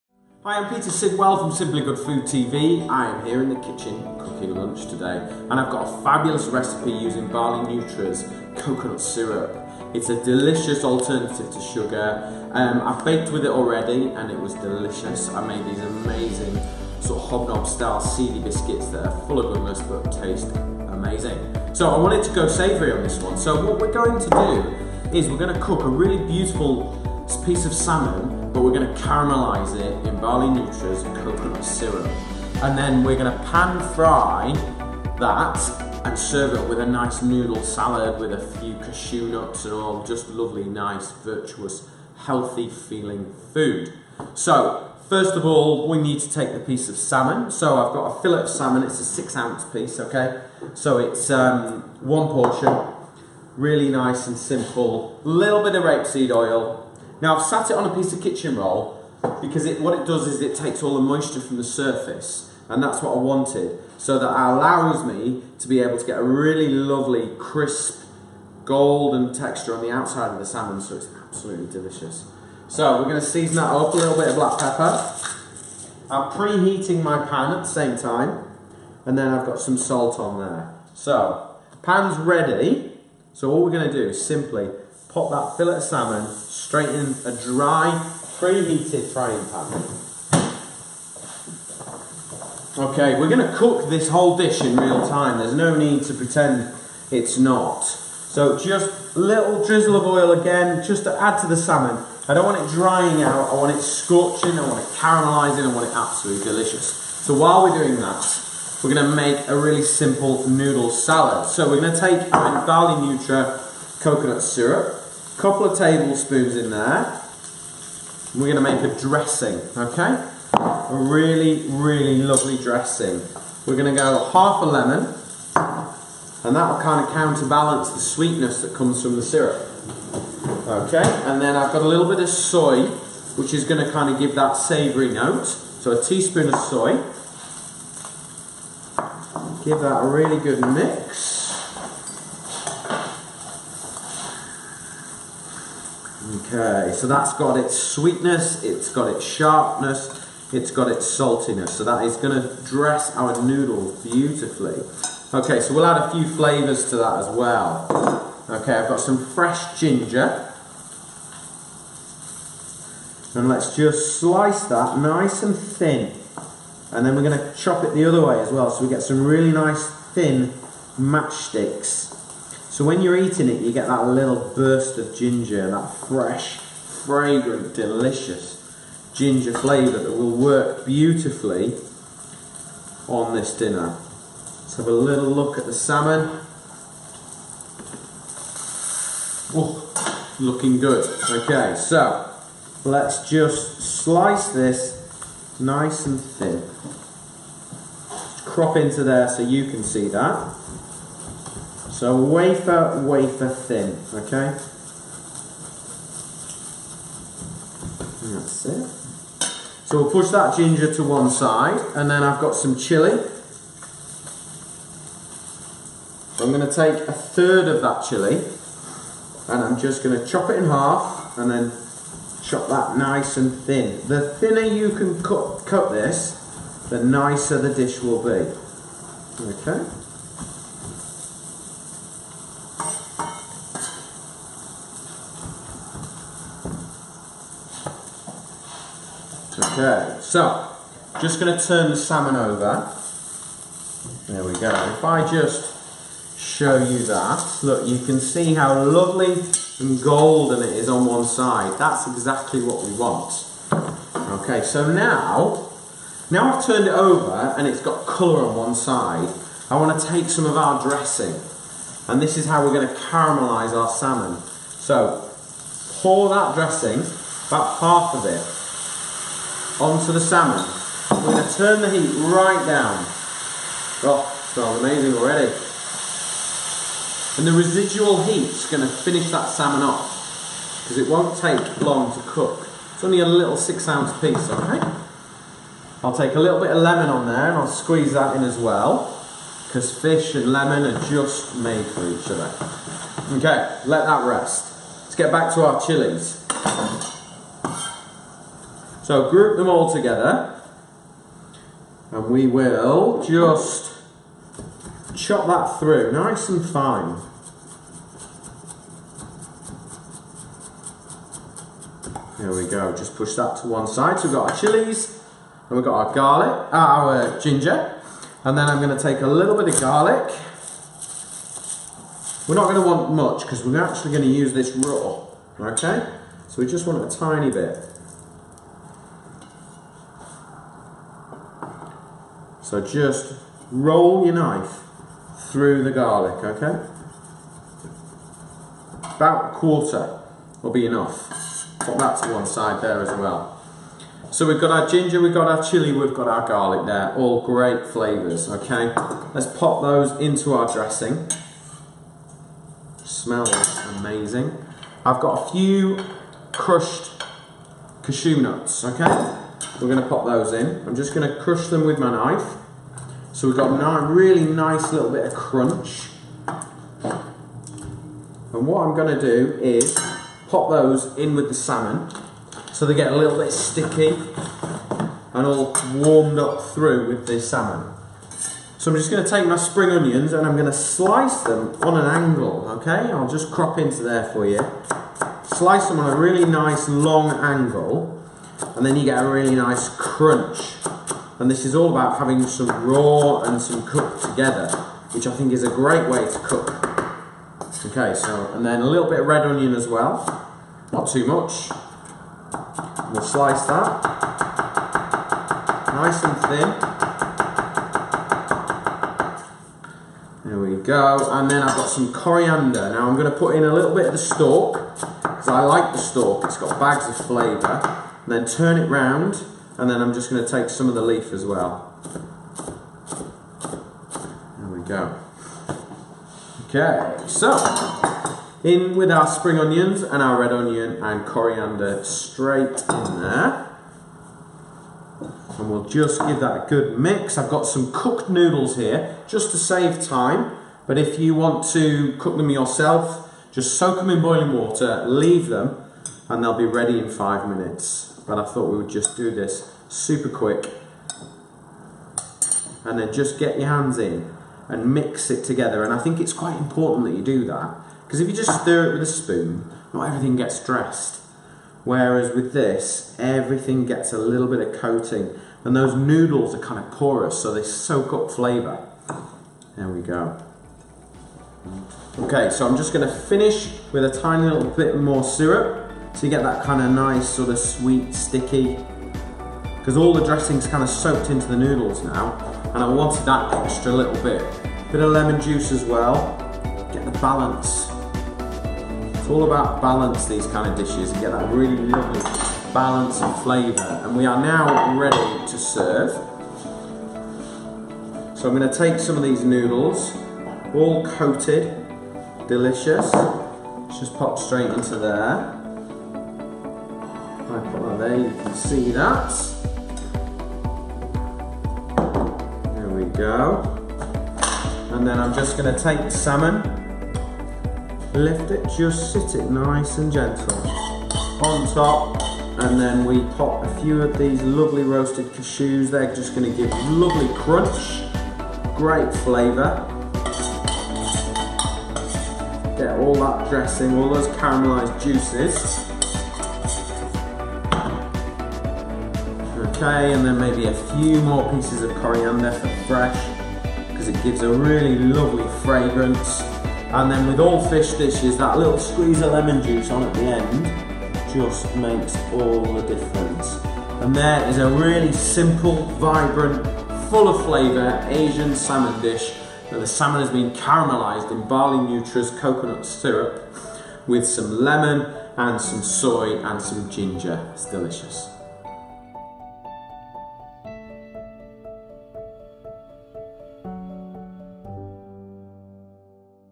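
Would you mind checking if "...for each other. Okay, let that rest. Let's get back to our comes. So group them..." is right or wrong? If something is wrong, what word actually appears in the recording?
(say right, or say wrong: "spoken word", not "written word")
wrong: "chilies", not "comes".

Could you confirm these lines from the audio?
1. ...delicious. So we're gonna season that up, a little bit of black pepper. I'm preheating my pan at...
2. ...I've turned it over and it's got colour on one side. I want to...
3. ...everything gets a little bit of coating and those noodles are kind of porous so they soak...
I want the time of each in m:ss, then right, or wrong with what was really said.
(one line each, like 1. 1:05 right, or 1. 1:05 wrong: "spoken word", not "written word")
1. 1:11 right
2. 4:16 right
3. 7:43 right.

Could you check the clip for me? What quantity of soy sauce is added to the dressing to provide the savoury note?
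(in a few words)
1 teaspoon.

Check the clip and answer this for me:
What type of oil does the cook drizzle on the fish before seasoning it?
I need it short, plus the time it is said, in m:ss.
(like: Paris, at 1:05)
Rapeseed oil, at 0:55.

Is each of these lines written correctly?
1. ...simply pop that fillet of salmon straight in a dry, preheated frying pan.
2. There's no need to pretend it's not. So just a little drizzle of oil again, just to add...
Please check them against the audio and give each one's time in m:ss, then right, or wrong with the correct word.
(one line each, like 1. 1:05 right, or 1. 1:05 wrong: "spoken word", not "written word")
1. 1:24 right
2. 1:35 right.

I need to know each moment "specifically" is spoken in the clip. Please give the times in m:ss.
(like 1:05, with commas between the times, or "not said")
not said.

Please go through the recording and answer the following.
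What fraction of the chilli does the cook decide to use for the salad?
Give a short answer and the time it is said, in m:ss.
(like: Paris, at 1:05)
A third, at 3:37.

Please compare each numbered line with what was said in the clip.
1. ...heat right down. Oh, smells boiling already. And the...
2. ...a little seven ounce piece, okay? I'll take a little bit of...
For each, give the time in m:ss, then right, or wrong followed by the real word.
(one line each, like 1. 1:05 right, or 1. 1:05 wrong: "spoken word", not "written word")
1. 4:31 wrong: "amazing", not "boiling"
2. 4:43 wrong: "six", not "seven".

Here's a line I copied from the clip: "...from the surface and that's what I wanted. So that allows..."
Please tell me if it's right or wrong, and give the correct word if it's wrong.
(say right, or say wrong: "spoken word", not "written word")
right.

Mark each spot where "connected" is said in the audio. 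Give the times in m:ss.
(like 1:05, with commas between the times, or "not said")
not said.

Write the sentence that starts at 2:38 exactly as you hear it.
Okay, I've got some fresh ginger.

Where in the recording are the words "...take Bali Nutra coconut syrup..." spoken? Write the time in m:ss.
1:51.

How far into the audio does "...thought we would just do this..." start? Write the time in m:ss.
7:28.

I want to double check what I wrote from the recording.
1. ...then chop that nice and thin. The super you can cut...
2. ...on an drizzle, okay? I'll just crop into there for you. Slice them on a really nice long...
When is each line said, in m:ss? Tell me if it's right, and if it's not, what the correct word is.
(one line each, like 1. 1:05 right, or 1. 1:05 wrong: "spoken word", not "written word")
1. 3:41 wrong: "thinner", not "super"
2. 6:21 wrong: "angle", not "drizzle".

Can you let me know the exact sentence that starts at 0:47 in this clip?
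So I've got a fillet of salmon, it's a six ounce piece, okay?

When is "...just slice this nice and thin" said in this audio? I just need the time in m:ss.
3:13.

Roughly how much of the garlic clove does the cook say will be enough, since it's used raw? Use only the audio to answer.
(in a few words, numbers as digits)
A quarter.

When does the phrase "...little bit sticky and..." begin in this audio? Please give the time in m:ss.
6:13.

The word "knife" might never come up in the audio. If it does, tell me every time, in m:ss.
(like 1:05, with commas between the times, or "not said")
5:34, 6:02.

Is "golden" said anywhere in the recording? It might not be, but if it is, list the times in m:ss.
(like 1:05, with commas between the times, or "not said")
1:08, 4:10.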